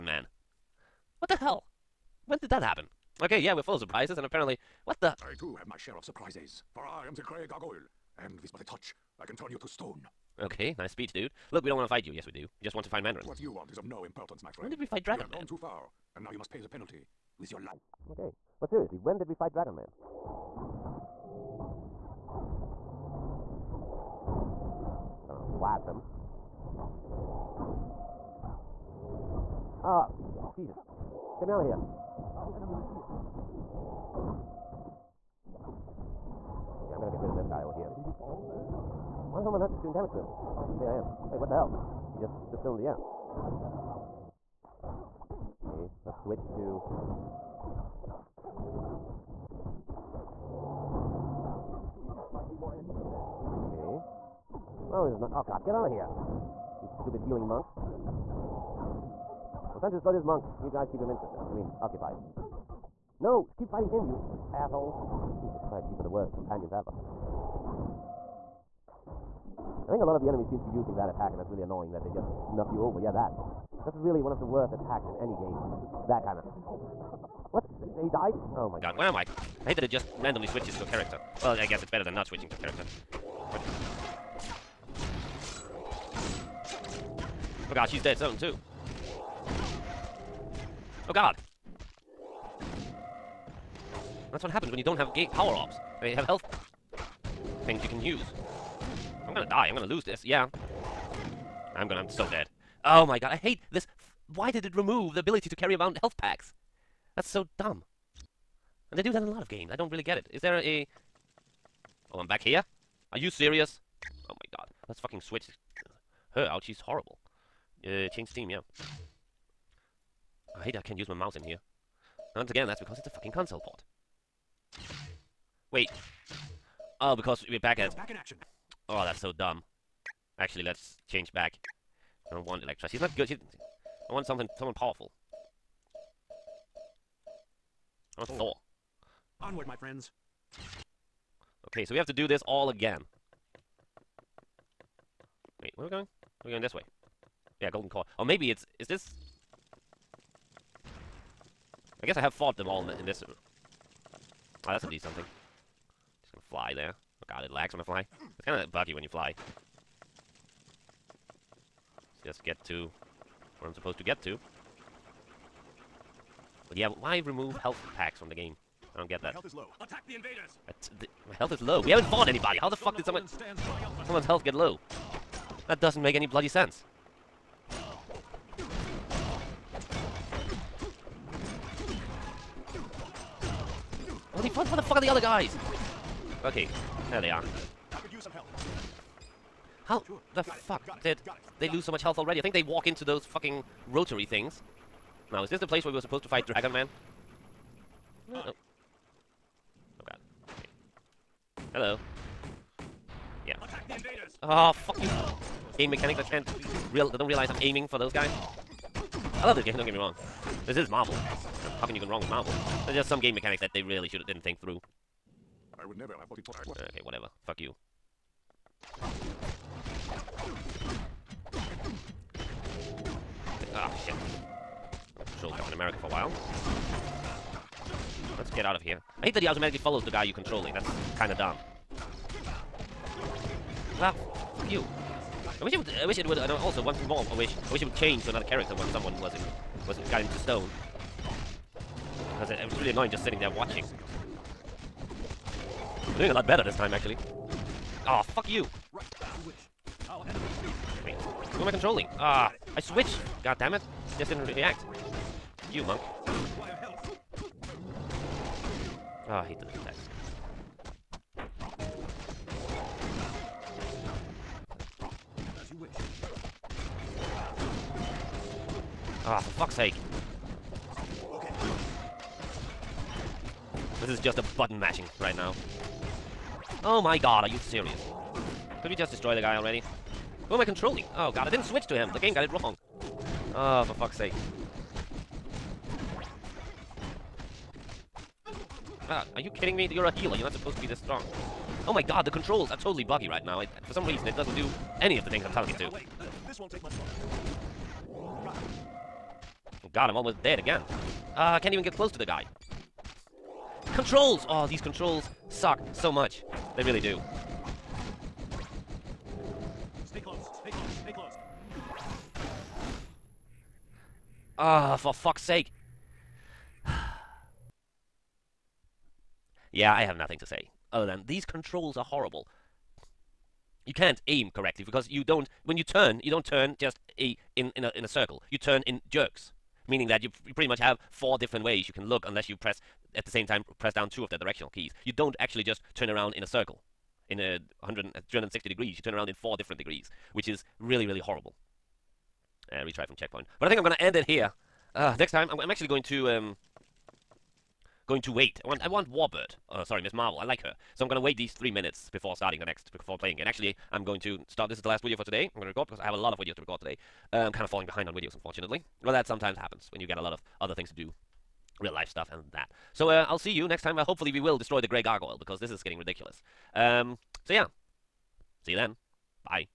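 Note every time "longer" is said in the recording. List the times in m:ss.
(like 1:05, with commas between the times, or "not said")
4:58.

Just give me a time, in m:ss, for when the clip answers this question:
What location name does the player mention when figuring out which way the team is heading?
2:27.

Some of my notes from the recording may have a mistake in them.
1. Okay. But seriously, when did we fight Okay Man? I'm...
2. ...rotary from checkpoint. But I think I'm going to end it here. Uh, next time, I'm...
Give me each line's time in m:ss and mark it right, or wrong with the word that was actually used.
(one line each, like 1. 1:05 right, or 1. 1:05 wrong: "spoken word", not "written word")
1. 0:18 wrong: "Dragon", not "Okay"
2. 5:42 wrong: "retry", not "rotary".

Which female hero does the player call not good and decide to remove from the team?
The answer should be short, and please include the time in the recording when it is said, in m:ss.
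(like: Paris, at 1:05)
Elektra, at 2:12.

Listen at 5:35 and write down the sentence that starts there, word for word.
You don't actually just turn around in a circle in uh, 100, uh, 360 degrees.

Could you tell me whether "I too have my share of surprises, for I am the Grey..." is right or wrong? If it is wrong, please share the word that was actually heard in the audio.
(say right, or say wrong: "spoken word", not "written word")
right.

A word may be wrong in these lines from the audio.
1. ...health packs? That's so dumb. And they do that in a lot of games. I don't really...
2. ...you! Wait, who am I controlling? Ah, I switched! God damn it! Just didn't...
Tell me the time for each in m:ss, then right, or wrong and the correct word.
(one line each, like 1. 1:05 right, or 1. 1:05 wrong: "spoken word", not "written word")
1. 1:46 right
2. 4:08 right.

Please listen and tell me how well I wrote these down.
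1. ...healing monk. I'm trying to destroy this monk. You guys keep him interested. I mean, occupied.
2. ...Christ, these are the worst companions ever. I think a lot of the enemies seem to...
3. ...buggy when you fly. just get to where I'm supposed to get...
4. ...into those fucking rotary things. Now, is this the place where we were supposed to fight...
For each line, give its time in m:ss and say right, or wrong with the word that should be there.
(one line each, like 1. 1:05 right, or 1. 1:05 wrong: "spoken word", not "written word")
1. 0:57 right
2. 1:05 right
3. 2:38 right
4. 3:12 right.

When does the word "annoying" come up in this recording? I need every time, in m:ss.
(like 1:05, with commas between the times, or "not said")
1:11, 4:02.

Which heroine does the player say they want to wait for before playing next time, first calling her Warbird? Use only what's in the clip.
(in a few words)
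Miss Marvel.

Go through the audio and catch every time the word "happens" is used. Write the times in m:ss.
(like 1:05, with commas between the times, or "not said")
0:02, 1:34, 5:59.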